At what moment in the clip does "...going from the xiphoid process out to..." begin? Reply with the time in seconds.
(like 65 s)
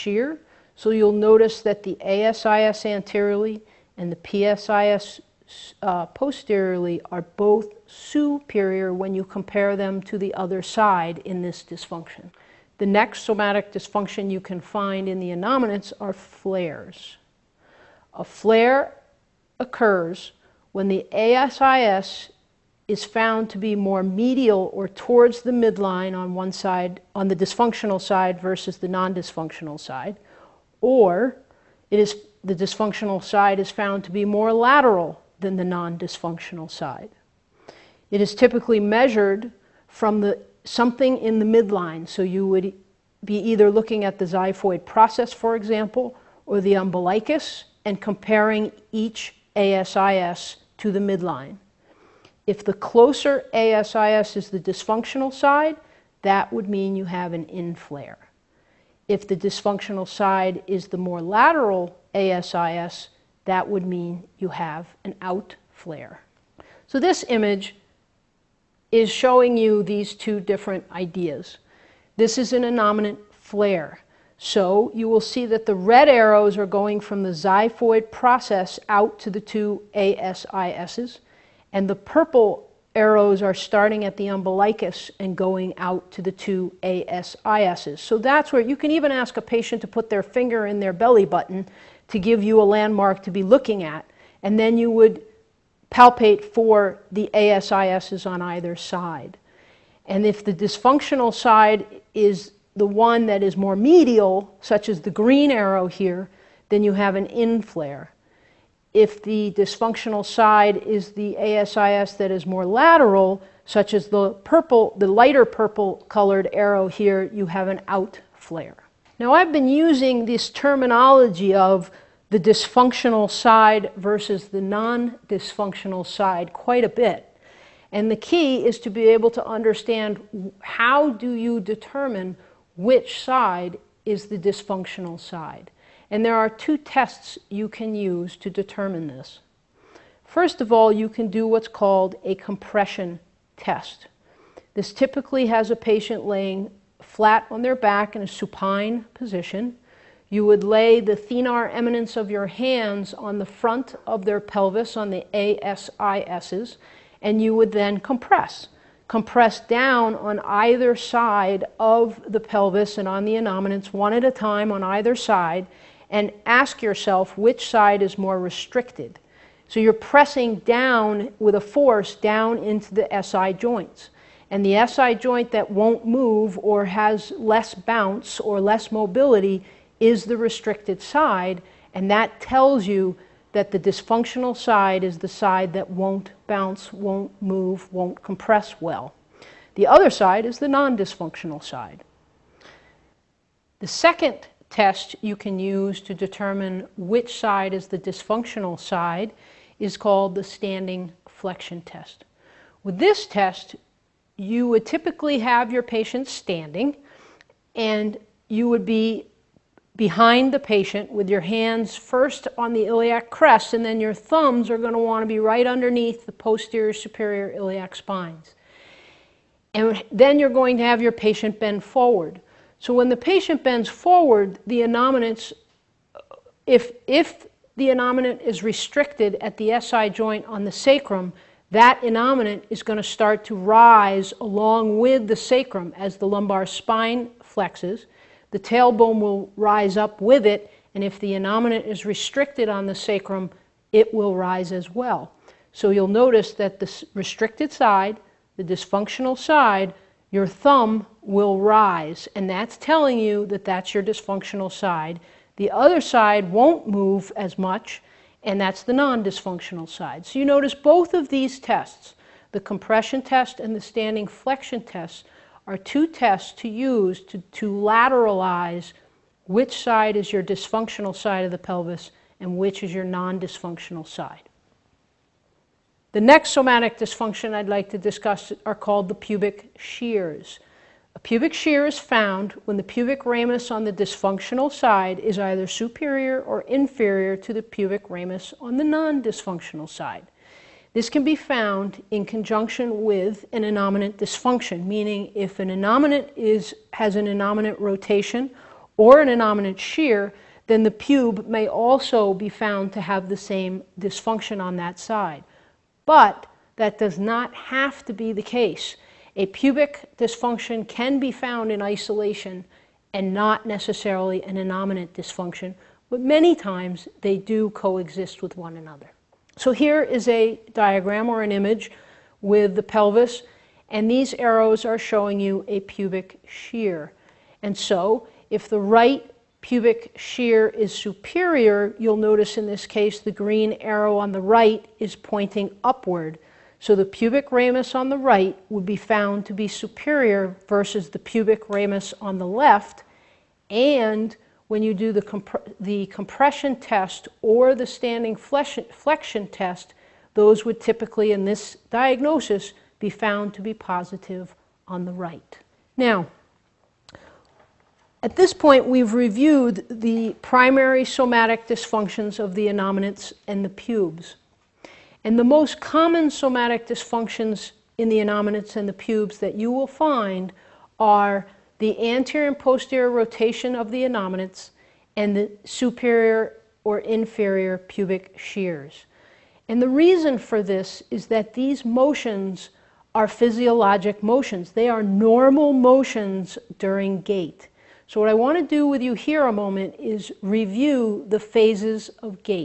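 76 s.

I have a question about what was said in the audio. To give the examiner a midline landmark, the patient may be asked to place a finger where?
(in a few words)
belly button.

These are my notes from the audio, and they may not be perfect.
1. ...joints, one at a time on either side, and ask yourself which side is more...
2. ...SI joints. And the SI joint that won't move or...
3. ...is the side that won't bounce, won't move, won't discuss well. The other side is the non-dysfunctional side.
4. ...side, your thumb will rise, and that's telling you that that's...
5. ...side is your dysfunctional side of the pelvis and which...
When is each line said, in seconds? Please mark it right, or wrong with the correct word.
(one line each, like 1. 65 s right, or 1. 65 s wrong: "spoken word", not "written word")
1. 163 s wrong: "innominants", not "joints"
2. 173 s right
3. 185 s wrong: "compress", not "discuss"
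4. 249 s right
5. 269 s right.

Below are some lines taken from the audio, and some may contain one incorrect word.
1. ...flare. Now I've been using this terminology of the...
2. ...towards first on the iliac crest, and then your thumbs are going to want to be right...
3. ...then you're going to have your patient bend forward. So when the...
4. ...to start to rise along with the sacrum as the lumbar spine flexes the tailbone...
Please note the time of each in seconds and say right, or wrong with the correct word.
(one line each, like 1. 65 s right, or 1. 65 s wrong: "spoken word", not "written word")
1. 118 s right
2. 211 s wrong: "hands", not "towards"
3. 220 s right
4. 232 s right.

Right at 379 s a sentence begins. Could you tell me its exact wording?
And the reason for this is that these motions are physiologic motions.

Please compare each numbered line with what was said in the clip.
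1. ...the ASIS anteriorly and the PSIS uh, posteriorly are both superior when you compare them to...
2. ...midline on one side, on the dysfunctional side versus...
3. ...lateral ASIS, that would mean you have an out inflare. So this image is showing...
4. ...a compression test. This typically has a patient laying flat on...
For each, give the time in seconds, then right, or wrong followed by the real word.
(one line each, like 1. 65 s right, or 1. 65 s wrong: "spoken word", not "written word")
1. 1 s right
2. 25 s right
3. 61 s wrong: "flare", not "inflare"
4. 142 s right.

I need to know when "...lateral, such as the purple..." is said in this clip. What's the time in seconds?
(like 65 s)
112 s.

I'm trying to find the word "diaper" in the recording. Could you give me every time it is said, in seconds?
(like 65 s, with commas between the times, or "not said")
not said.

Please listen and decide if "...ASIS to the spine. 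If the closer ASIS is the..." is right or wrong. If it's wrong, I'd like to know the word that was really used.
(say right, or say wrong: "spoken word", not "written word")
wrong: "midline", not "spine".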